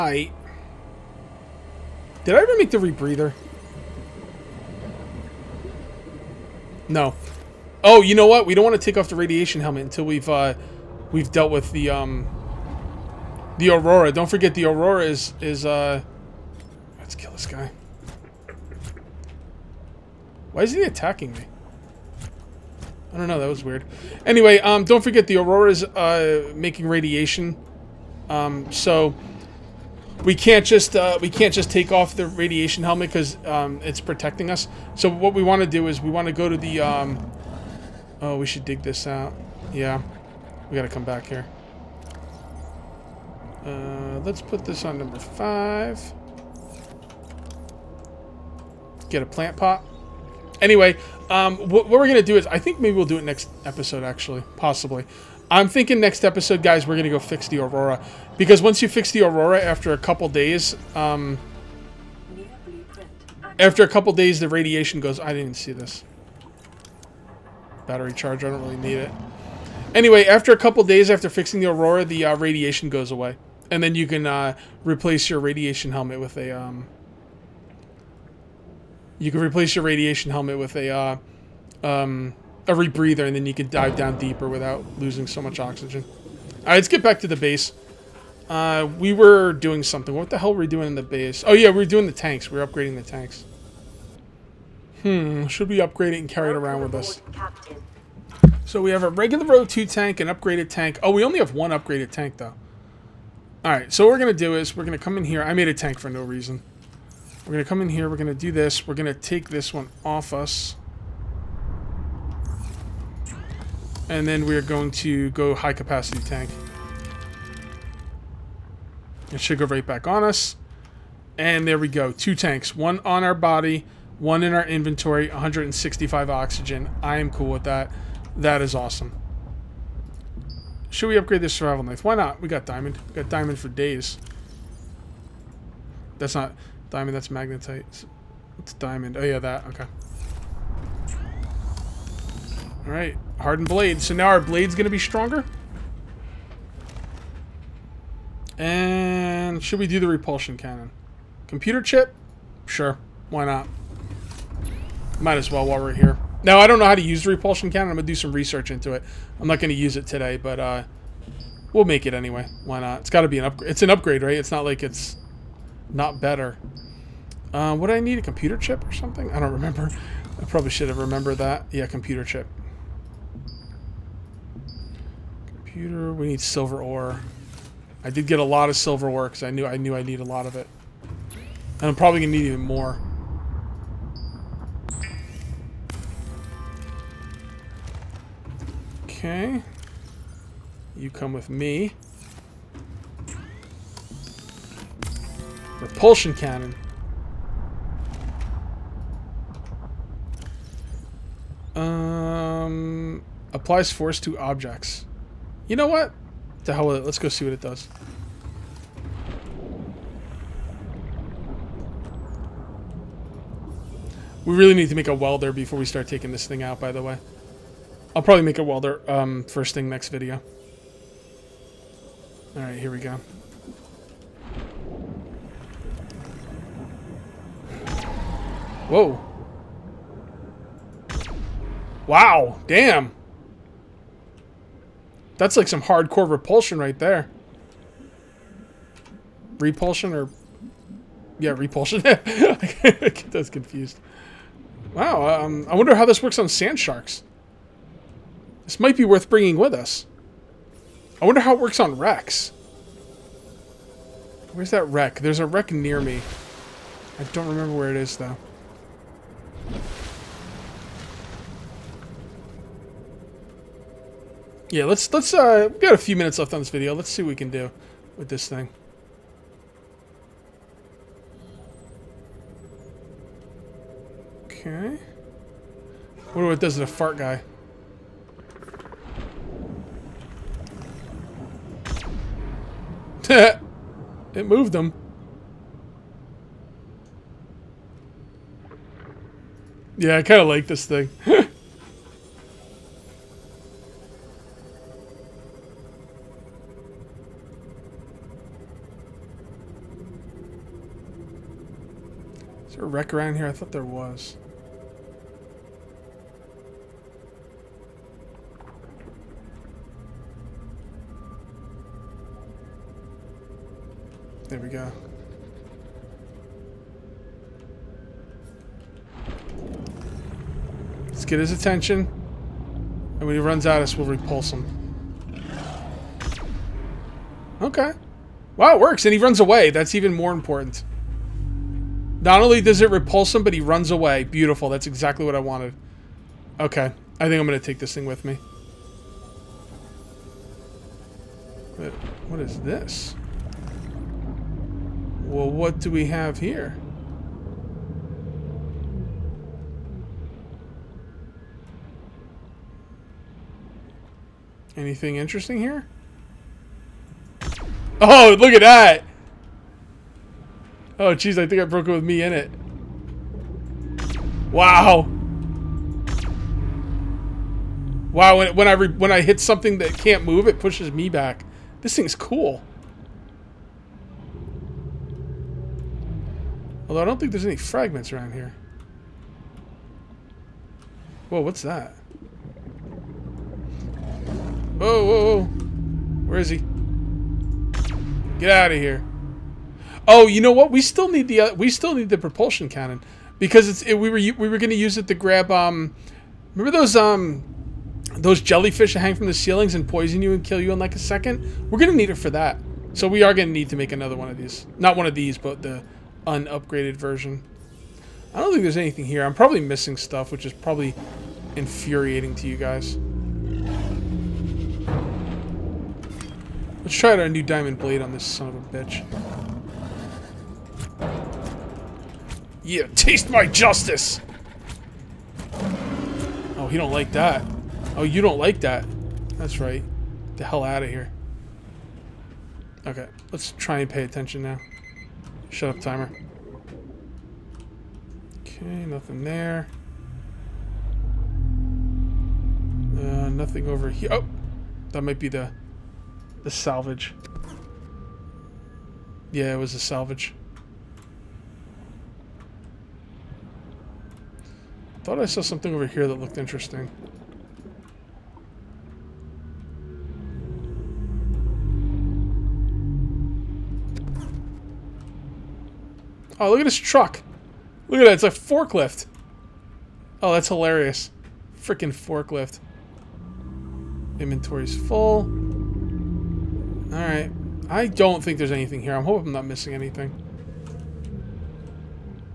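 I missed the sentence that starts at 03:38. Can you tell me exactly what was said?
I'll probably make a welder um, first thing next video.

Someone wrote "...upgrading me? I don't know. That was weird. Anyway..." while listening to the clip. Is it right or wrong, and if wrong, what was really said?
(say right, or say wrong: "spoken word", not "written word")
wrong: "attacking", not "upgrading".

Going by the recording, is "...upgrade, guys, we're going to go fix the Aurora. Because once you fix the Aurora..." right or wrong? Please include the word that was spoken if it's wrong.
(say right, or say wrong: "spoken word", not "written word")
wrong: "episode", not "upgrade".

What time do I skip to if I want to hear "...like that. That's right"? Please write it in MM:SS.
07:08.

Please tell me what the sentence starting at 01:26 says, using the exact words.
All right, let's get back to the base.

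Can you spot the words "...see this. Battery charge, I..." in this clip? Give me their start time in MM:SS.
01:05.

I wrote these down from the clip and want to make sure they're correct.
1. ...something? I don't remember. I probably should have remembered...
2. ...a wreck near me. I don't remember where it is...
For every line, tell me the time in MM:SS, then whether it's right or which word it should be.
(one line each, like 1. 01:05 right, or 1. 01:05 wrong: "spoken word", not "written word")
1. 02:48 right
2. 04:15 right.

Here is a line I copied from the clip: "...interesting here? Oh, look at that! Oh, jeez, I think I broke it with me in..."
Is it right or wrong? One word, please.
right.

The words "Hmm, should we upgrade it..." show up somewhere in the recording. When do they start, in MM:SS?
01:35.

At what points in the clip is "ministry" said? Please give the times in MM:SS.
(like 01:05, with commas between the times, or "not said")
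not said.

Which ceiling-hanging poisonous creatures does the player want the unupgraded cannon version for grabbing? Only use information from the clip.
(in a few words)
jellyfish.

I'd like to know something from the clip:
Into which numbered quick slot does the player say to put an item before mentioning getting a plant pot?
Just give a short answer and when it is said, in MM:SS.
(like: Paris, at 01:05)
5, at 00:44.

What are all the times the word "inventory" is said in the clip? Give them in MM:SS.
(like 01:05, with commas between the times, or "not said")
02:04, 07:54.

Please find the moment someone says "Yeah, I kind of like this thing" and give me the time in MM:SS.
04:49.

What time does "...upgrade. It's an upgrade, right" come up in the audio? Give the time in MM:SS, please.
02:43.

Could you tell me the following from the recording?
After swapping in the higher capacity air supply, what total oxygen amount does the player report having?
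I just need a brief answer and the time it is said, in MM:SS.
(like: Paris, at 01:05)
165, at 02:05.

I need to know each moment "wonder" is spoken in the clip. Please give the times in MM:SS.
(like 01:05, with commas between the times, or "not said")
04:05, 04:11, 04:36.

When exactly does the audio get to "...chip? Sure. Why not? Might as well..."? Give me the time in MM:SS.
02:31.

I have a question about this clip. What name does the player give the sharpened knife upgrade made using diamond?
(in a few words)
Hardened blade.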